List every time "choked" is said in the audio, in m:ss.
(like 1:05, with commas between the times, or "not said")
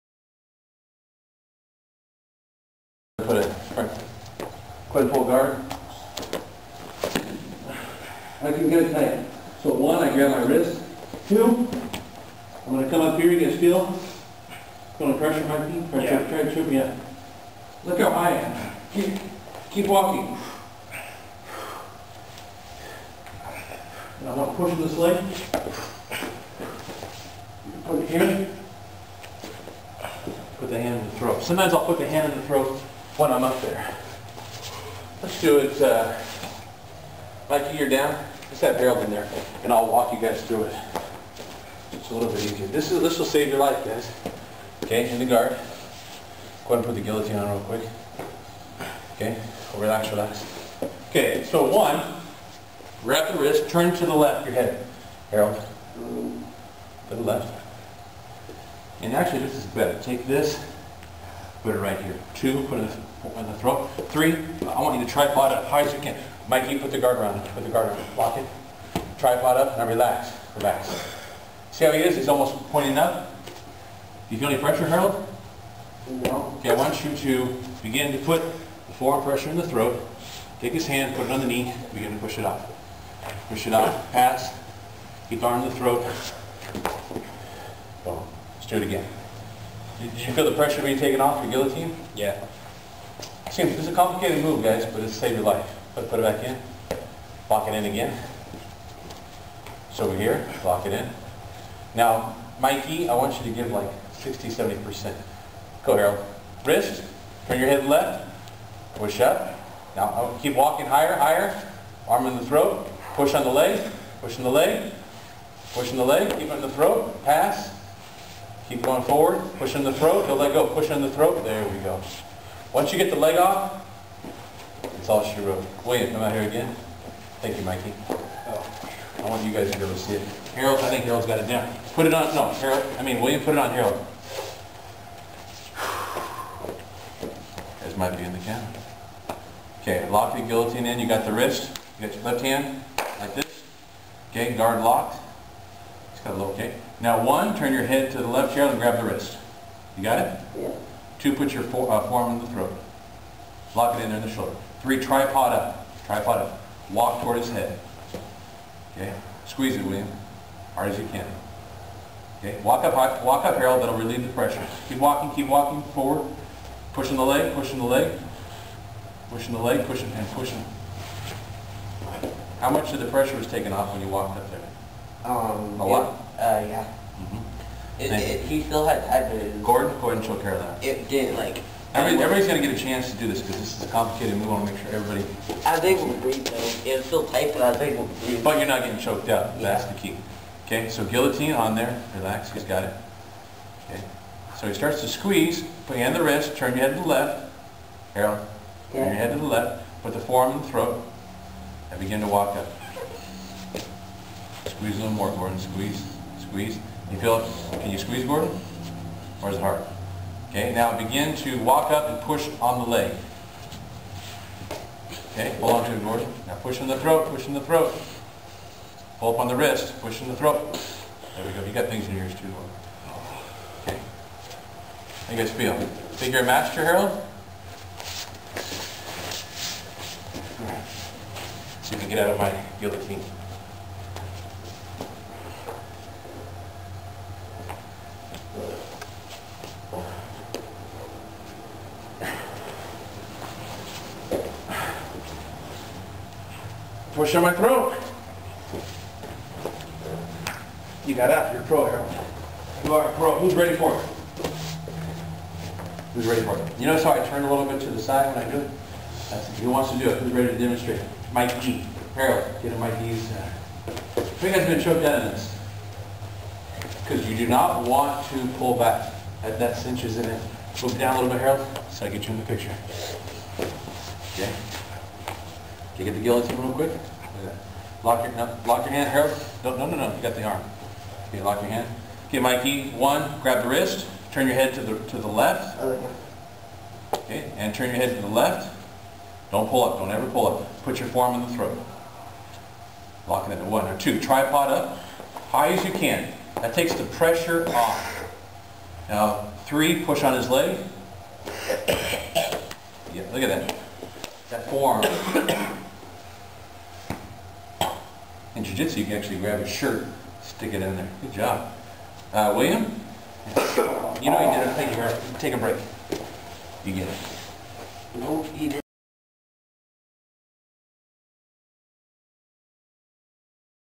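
3:09, 4:24.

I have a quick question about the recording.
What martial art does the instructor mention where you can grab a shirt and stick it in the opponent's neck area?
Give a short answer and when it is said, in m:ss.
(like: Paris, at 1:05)
Jiu-jitsu, at 5:08.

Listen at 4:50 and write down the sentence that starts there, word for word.
Put your forearm in the throat.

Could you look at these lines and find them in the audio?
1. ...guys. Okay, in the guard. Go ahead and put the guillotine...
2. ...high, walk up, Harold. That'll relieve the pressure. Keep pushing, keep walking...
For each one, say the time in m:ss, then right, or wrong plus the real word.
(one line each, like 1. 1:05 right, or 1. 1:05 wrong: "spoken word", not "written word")
1. 0:43 right
2. 2:42 wrong: "walking", not "pushing".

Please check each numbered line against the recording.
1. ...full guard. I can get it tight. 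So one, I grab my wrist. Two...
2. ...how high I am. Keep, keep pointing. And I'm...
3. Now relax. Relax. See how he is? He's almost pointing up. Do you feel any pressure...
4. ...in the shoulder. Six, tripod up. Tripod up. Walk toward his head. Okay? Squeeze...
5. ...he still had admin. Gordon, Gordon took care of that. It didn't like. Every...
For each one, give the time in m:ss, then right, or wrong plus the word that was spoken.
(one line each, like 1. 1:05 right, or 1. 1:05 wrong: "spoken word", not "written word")
1. 0:05 right
2. 0:17 wrong: "walking", not "pointing"
3. 1:09 right
4. 2:34 wrong: "Three", not "Six"
5. 2:58 right.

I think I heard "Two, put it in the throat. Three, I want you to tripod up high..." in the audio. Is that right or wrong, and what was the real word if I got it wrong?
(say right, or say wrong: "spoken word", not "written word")
right.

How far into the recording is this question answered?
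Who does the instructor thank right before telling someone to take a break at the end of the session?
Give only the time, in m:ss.
5:15.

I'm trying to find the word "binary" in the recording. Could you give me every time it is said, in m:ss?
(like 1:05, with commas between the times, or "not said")
not said.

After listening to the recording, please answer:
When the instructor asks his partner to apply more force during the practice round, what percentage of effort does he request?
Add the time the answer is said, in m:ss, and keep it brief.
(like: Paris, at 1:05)
60, 70%, at 1:44.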